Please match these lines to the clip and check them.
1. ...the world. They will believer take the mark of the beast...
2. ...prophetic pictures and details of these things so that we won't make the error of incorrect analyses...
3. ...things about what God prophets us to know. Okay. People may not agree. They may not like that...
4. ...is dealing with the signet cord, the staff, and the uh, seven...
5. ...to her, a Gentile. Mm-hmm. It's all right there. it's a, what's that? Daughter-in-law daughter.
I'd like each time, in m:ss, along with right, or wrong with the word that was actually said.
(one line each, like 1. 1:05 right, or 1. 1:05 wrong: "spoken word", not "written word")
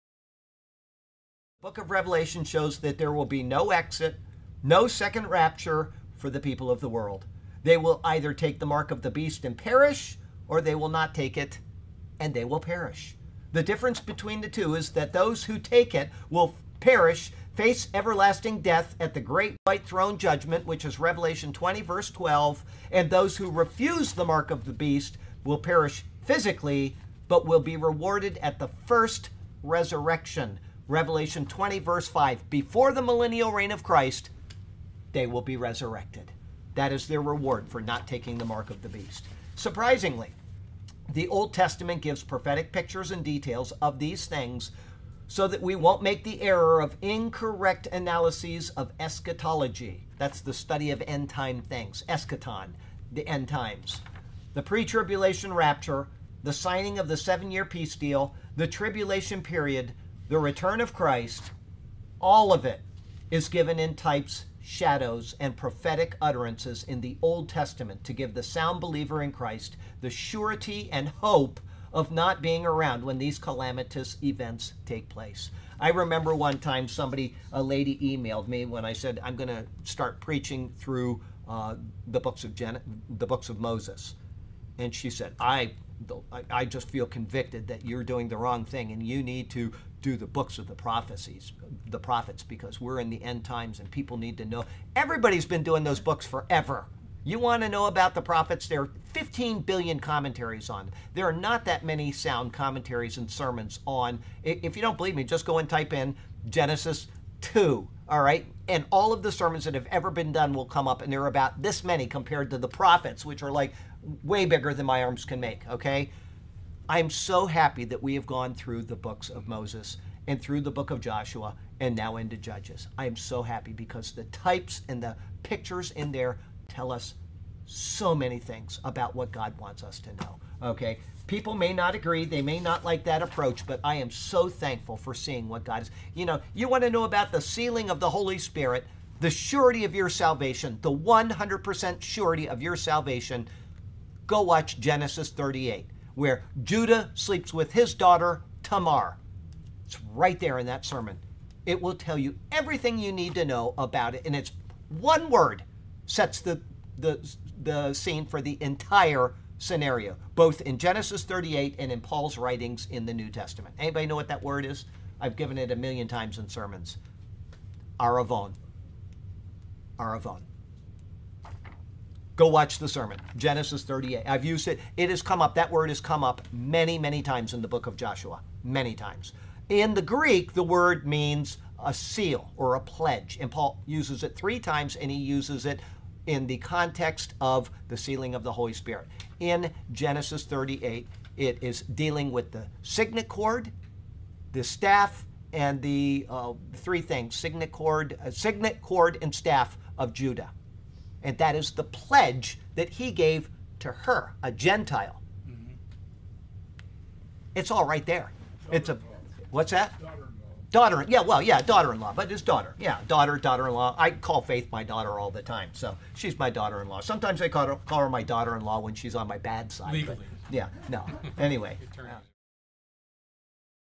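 1. 0:06 wrong: "either", not "believer"
2. 0:42 right
3. 2:08 wrong: "wants", not "prophets"
4. 3:11 wrong: "three", not "seven"
5. 3:23 right.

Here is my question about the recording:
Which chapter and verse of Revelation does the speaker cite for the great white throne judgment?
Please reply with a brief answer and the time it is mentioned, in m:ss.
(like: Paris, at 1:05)
Revelation 20:12, at 0:20.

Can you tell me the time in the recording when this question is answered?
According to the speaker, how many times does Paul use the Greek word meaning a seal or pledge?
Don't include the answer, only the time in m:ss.
3:04.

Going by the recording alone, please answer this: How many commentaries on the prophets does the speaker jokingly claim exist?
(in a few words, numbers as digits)
15 billion.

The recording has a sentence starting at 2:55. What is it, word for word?
That word has come up many, many times in the book of Joshua.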